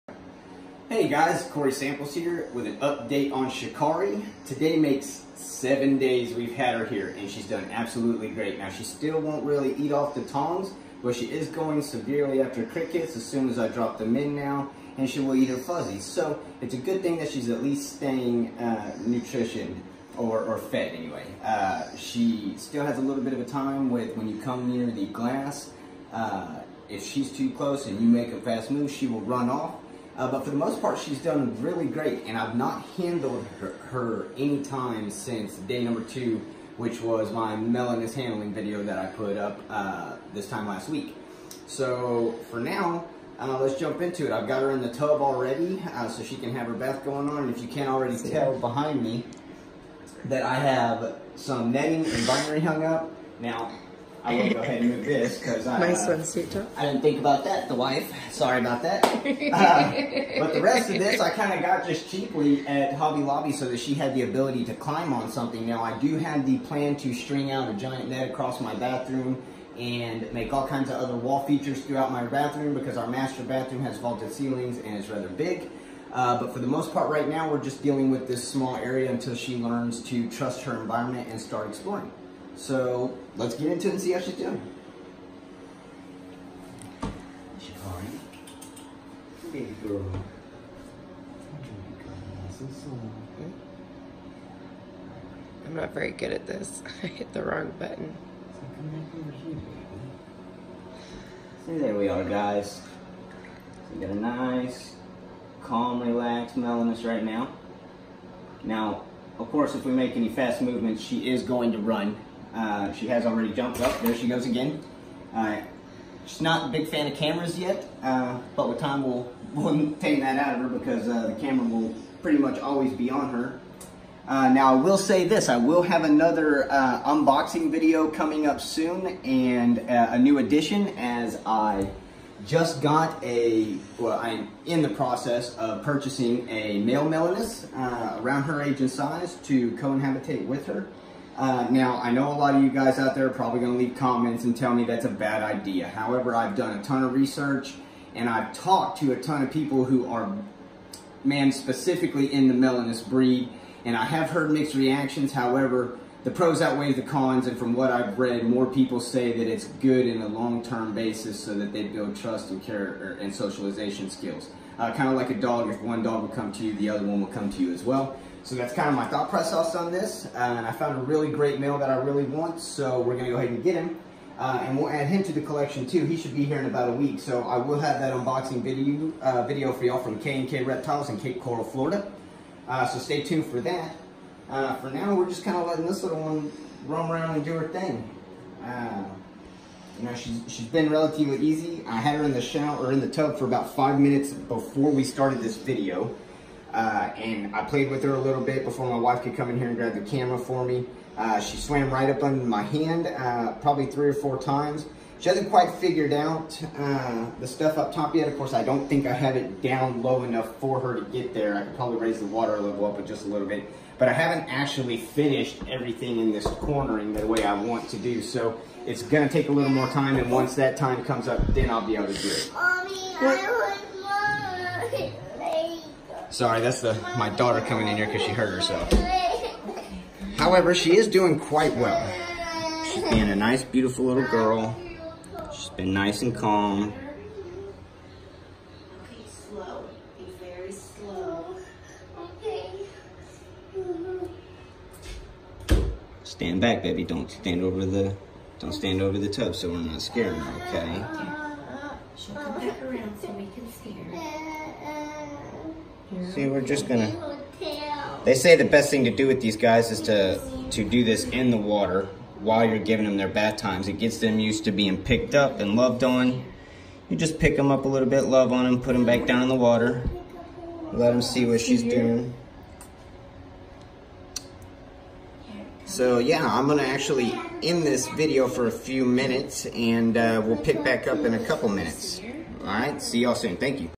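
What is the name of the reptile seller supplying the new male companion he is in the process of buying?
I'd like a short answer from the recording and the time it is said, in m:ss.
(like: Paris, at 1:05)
K&K Reptiles, at 3:00.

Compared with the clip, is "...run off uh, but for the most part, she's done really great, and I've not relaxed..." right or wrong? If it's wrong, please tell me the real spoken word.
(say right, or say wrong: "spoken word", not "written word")
wrong: "handled", not "relaxed".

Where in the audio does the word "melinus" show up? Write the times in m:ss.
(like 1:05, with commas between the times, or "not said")
1:46, 2:17, 2:32.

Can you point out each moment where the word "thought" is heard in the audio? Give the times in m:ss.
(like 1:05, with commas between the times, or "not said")
2:49.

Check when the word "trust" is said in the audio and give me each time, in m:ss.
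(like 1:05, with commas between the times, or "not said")
1:20, 2:42.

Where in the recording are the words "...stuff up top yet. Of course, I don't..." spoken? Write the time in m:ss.
3:27.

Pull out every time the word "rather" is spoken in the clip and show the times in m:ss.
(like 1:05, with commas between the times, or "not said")
1:15.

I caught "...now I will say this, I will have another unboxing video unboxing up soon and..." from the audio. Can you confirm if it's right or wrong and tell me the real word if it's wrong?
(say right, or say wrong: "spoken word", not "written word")
wrong: "coming", not "unboxing".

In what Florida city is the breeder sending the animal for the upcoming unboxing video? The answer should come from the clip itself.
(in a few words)
Cape Coral.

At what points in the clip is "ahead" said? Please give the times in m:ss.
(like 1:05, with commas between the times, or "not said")
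0:54, 2:53.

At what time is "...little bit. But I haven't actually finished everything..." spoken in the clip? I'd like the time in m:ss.
3:33.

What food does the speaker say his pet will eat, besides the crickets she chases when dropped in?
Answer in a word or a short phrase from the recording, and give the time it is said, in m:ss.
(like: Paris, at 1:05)
fuzzies, at 0:15.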